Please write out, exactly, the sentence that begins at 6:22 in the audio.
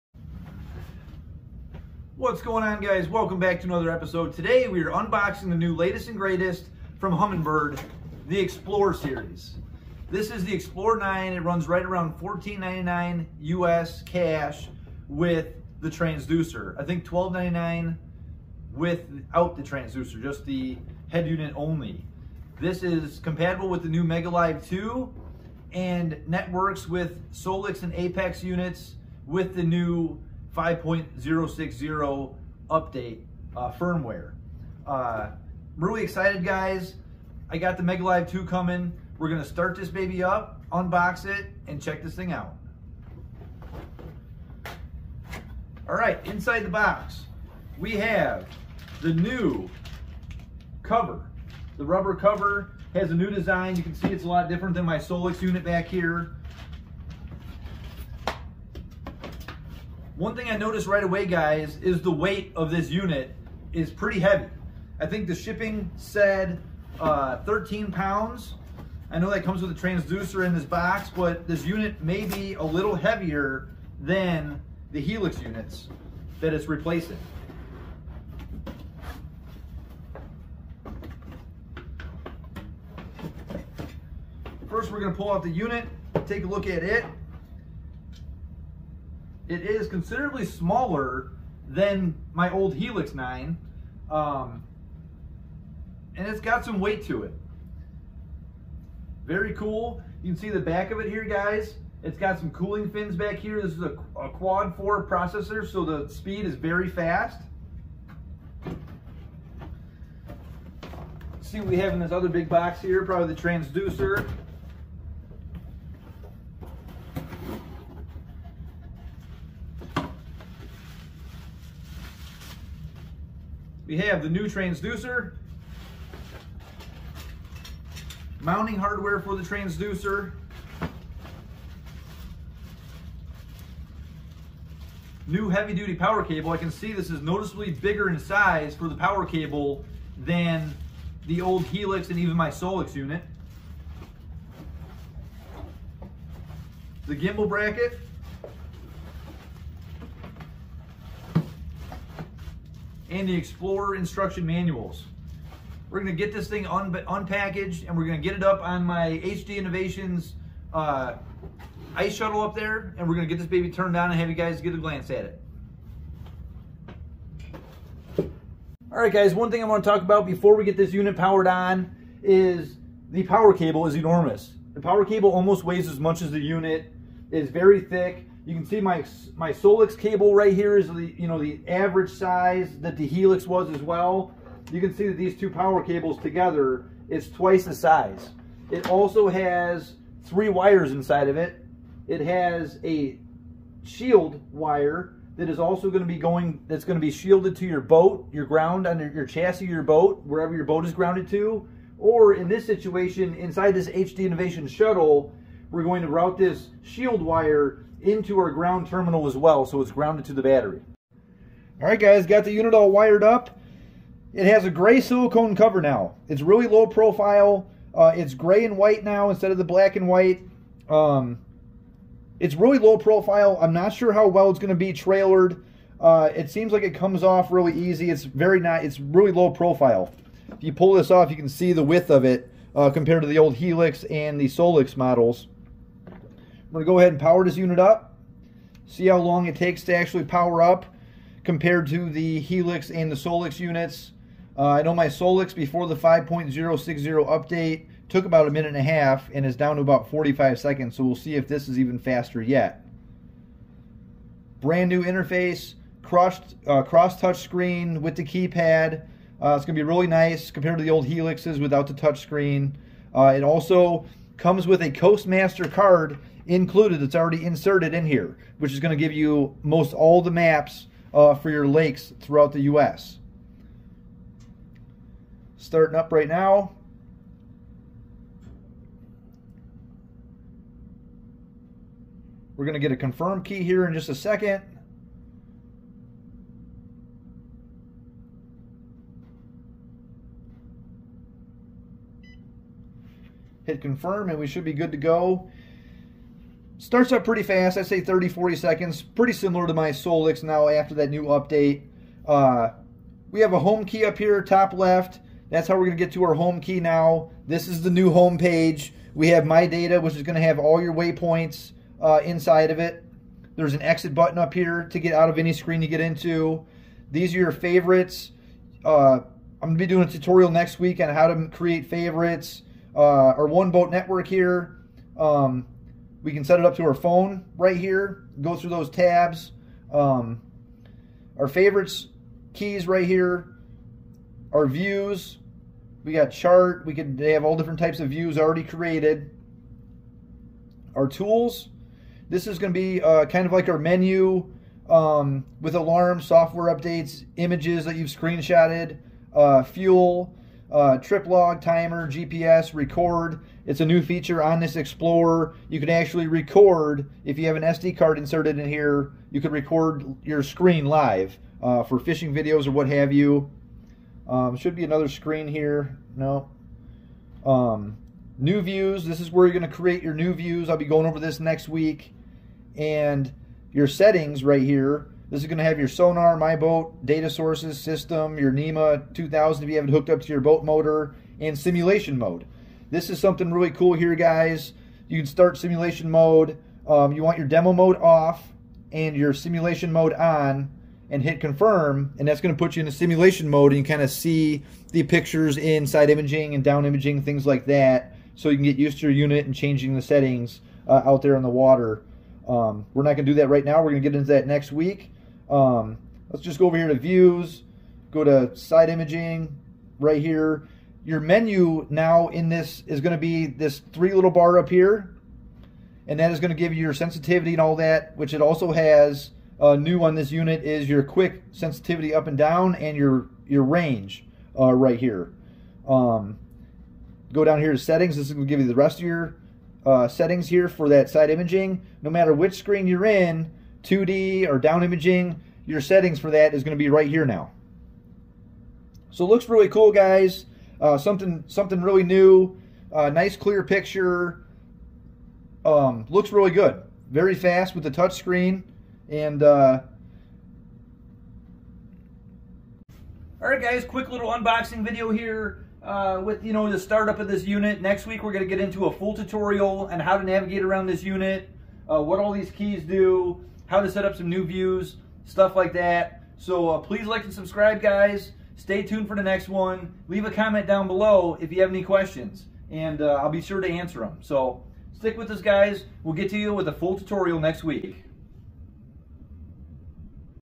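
This is something really cool here, guys.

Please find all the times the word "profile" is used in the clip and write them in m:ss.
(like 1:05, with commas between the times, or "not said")
3:36, 3:42, 3:49.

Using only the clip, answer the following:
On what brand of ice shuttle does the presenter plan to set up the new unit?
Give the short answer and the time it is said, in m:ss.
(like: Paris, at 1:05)
HD Innovations, at 2:39.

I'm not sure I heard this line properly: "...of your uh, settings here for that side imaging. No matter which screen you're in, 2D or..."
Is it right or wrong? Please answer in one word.
right.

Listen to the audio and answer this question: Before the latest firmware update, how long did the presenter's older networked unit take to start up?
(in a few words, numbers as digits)
a minute and a half.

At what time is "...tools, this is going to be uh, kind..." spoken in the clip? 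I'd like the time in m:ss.
5:41.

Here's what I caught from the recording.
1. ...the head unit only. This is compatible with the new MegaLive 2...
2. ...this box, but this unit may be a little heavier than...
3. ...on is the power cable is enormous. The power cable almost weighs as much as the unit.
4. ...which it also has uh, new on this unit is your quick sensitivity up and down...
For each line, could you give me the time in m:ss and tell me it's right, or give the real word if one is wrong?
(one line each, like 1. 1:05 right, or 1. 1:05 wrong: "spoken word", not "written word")
1. 0:20 right
2. 1:10 right
3. 2:51 right
4. 6:58 right.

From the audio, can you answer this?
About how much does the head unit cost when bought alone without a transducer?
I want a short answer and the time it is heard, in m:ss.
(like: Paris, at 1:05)
$12.99, at 0:17.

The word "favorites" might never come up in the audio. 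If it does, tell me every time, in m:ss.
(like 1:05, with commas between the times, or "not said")
5:17, 5:21, 5:31.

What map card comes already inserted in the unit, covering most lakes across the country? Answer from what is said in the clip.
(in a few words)
Coastmaster card.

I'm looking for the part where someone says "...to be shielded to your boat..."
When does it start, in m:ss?
3:16.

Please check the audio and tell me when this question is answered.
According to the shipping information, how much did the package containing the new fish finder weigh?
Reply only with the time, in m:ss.
1:07.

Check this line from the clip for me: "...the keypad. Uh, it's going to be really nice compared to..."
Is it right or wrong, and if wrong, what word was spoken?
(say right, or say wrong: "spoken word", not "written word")
right.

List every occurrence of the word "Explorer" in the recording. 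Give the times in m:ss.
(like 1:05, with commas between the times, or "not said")
2:33, 5:54.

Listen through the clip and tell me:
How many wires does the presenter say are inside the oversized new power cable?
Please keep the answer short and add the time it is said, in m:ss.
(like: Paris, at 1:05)
3, at 3:10.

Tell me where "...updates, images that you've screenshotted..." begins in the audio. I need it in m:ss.
5:46.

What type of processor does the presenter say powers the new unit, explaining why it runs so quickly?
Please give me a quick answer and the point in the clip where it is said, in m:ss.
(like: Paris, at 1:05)
quad four processor, at 1:44.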